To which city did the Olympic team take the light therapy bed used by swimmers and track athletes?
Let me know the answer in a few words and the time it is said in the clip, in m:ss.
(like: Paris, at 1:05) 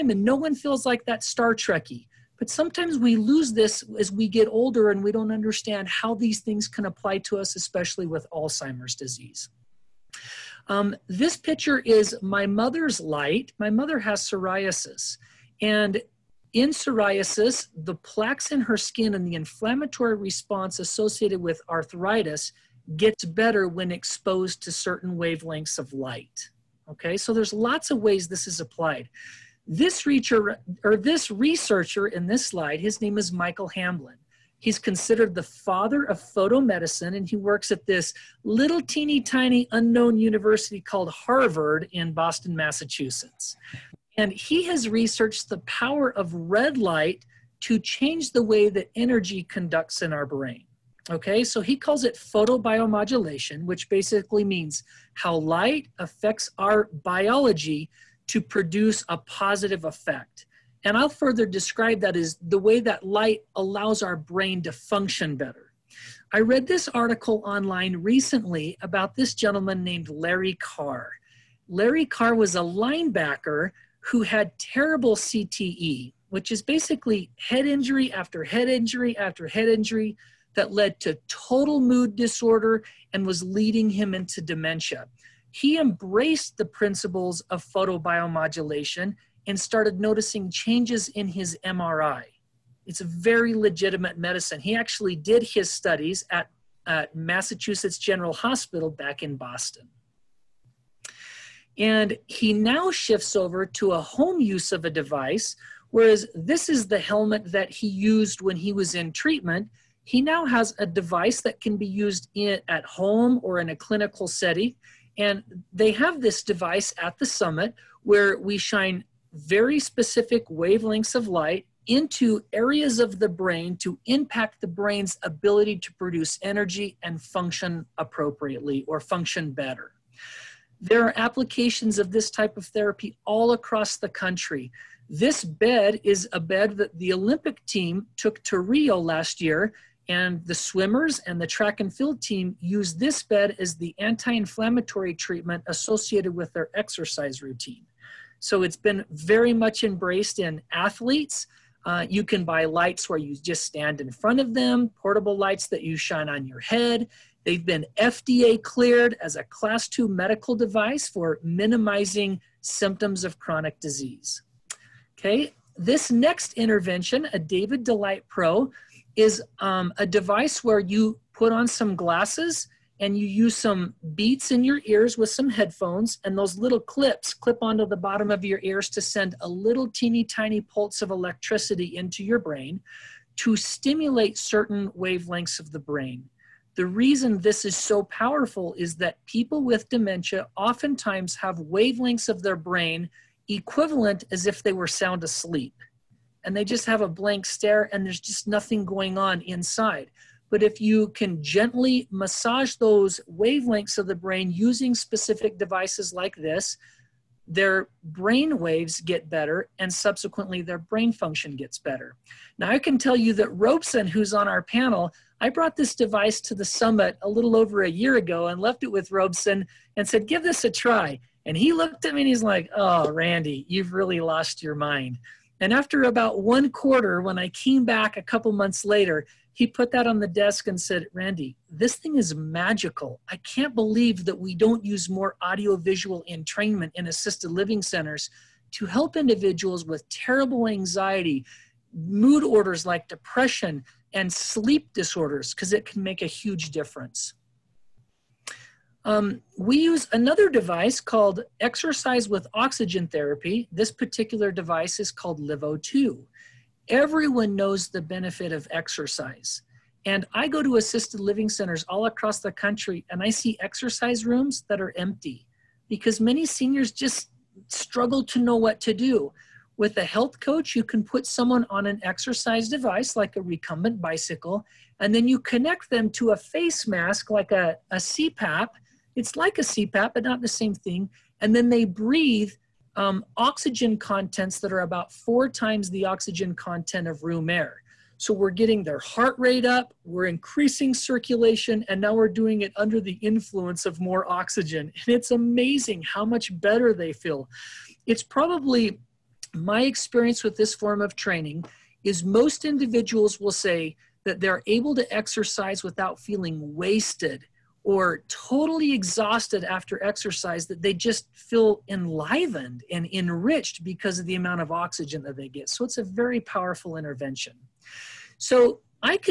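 Rio, at 2:18.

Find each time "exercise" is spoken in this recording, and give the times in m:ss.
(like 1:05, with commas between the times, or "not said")
2:26, 4:11, 4:18, 4:23, 4:32, 5:05, 5:10.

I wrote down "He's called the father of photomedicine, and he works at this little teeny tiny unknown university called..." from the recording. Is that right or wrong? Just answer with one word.
wrong.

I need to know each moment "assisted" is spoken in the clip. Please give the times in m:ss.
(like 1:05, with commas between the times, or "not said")
3:57, 4:20.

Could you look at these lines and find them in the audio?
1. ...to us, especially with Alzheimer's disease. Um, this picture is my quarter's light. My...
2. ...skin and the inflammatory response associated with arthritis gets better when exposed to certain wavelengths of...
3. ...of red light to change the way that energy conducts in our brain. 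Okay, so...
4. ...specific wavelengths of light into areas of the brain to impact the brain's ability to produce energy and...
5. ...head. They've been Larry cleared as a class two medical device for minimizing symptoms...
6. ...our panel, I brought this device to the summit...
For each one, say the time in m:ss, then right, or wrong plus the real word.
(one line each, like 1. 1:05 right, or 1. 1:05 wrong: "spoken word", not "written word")
1. 0:07 wrong: "mother", not "quarter"
2. 0:18 right
3. 0:46 right
4. 1:59 right
5. 2:36 wrong: "FDA", not "Larry"
6. 3:34 right.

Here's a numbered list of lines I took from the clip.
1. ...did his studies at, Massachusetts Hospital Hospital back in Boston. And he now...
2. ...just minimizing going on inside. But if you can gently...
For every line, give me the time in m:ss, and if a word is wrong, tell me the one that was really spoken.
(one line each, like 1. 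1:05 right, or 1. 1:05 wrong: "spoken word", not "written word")
1. 1:35 wrong: "General", not "Hospital"
2. 3:18 wrong: "nothing", not "minimizing".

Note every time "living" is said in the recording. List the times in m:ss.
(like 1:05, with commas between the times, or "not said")
3:57, 4:21.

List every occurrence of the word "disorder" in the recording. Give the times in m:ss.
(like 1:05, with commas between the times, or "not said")
1:22, 4:04.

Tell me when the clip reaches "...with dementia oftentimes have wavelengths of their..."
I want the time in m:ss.
3:09.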